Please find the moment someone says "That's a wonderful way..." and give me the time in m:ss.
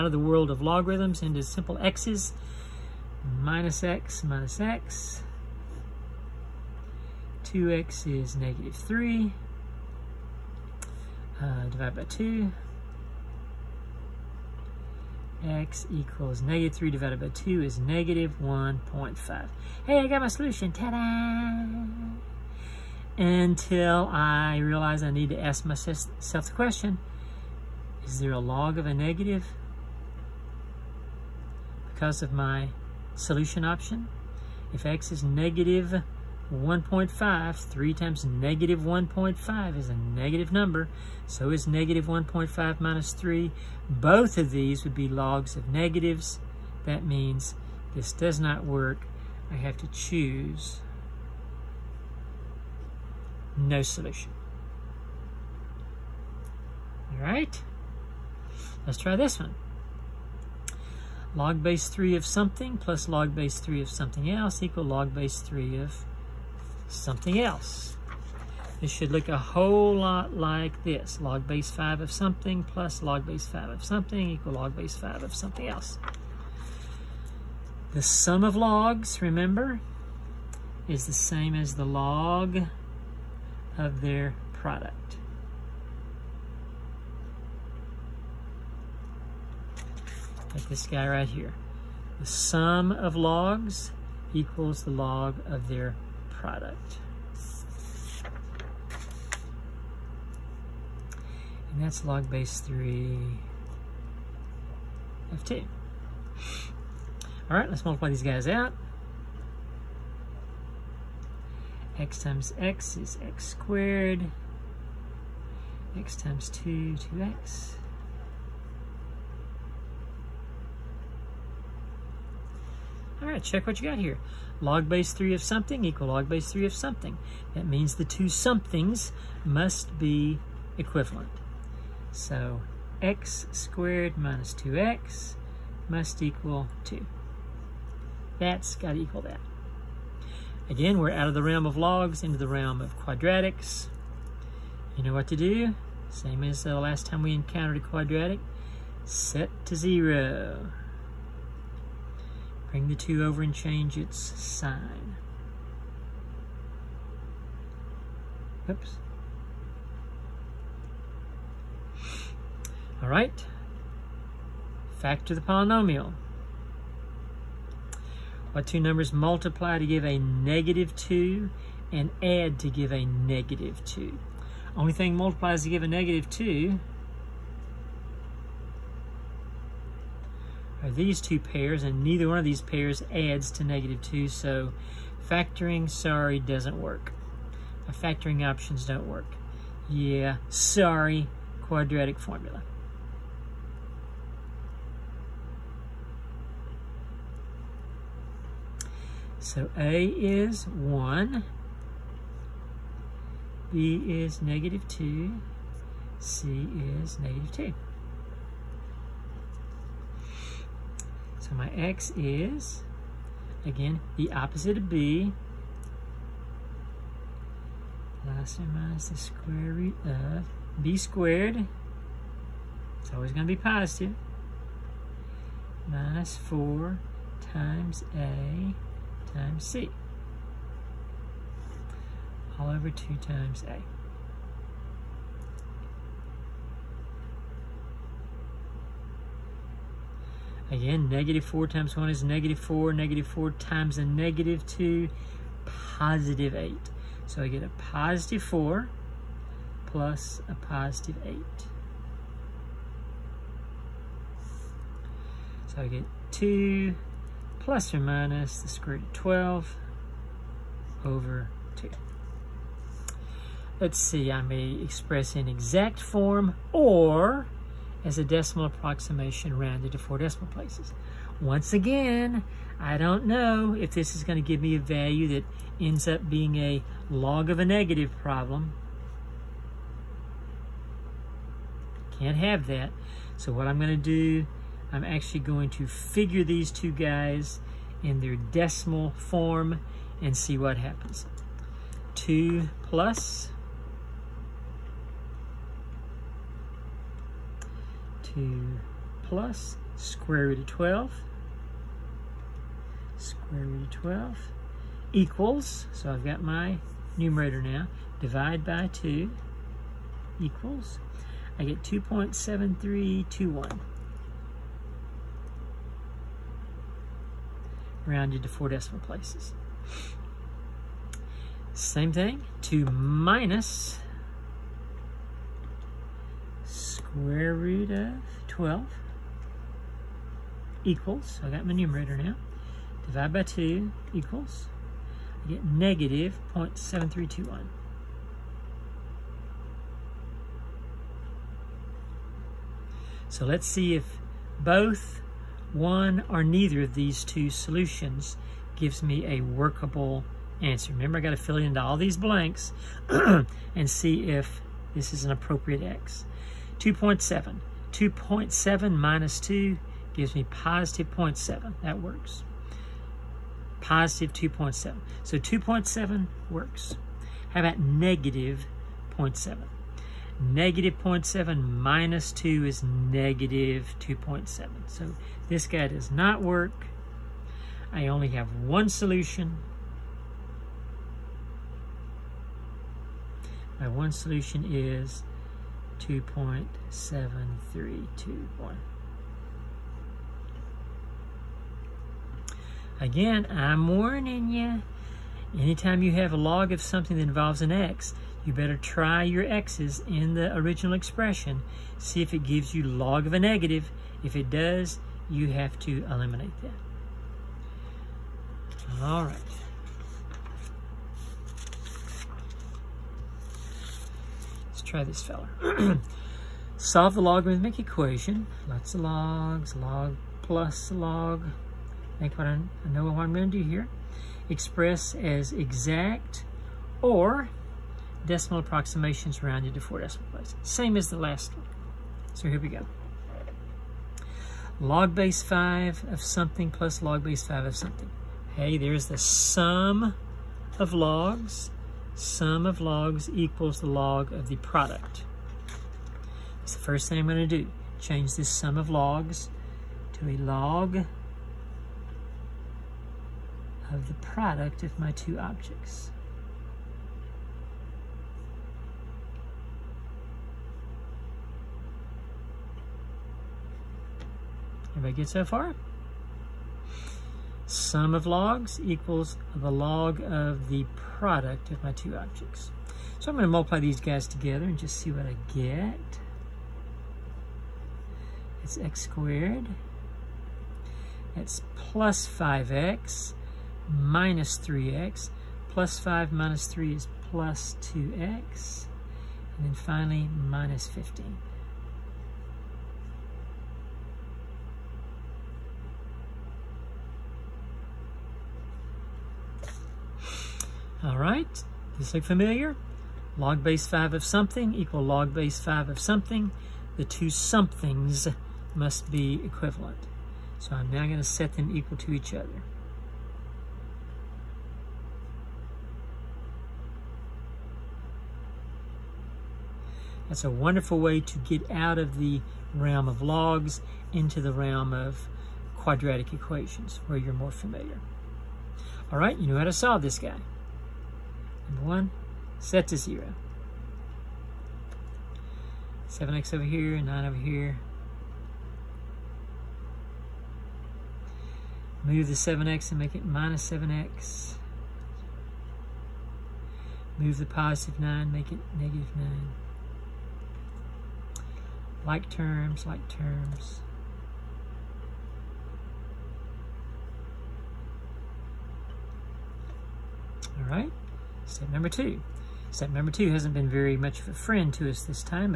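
8:40.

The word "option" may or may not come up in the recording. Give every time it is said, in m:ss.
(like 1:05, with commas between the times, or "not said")
0:33, 3:08.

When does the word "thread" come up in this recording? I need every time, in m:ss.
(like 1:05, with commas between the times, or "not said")
not said.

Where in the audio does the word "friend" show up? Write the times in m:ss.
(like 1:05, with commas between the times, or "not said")
9:24.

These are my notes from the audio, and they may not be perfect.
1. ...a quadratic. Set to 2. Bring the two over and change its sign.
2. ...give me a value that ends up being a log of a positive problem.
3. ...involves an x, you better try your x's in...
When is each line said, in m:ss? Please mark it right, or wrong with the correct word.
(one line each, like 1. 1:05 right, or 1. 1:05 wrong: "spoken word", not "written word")
1. 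2:27 wrong: "0", not "2"
2. 4:34 wrong: "negative", not "positive"
3. 6:37 right.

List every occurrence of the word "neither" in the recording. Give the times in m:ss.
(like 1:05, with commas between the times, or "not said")
3:02, 5:46.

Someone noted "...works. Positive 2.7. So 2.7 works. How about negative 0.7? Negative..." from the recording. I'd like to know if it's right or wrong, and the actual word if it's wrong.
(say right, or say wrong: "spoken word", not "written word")
right.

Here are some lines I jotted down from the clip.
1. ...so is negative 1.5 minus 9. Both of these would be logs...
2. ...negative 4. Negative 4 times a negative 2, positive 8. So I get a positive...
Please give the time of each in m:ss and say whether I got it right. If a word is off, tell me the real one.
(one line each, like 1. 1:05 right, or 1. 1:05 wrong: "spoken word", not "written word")
1. 0:41 wrong: "3", not "9"
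2. 4:02 right.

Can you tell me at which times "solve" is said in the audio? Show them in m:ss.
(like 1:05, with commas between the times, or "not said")
6:56, 8:49.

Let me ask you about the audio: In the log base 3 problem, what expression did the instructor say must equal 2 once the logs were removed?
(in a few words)
x squared minus 2x.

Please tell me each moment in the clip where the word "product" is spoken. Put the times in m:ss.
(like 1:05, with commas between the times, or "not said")
1:24, 1:36, 7:24, 7:34, 7:51.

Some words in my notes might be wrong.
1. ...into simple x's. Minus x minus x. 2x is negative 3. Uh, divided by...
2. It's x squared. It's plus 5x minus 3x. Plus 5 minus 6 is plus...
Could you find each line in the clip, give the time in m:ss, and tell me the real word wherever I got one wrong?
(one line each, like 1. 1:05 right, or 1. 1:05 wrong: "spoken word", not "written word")
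1. 0:01 right
2. 7:58 wrong: "3", not "6".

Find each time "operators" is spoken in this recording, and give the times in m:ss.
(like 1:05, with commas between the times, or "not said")
not said.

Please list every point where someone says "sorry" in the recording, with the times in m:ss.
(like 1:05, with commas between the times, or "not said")
3:05, 3:10.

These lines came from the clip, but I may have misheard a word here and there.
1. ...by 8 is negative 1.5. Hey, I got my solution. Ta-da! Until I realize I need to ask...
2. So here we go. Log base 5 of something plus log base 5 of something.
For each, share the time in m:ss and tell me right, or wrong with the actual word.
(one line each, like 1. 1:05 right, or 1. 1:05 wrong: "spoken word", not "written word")
1. 0:17 wrong: "2", not "8"
2. 7:12 right.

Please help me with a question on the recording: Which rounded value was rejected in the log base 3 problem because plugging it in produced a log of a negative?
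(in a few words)
-0.7321.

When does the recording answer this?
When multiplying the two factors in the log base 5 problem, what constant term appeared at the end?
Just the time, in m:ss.
8:10.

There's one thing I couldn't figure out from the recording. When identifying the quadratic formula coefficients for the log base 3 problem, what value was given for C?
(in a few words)
-2.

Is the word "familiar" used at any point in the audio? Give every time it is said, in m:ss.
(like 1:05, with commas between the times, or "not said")
8:22, 8:47.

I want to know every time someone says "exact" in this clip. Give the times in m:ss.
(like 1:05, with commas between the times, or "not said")
4:25, 7:05.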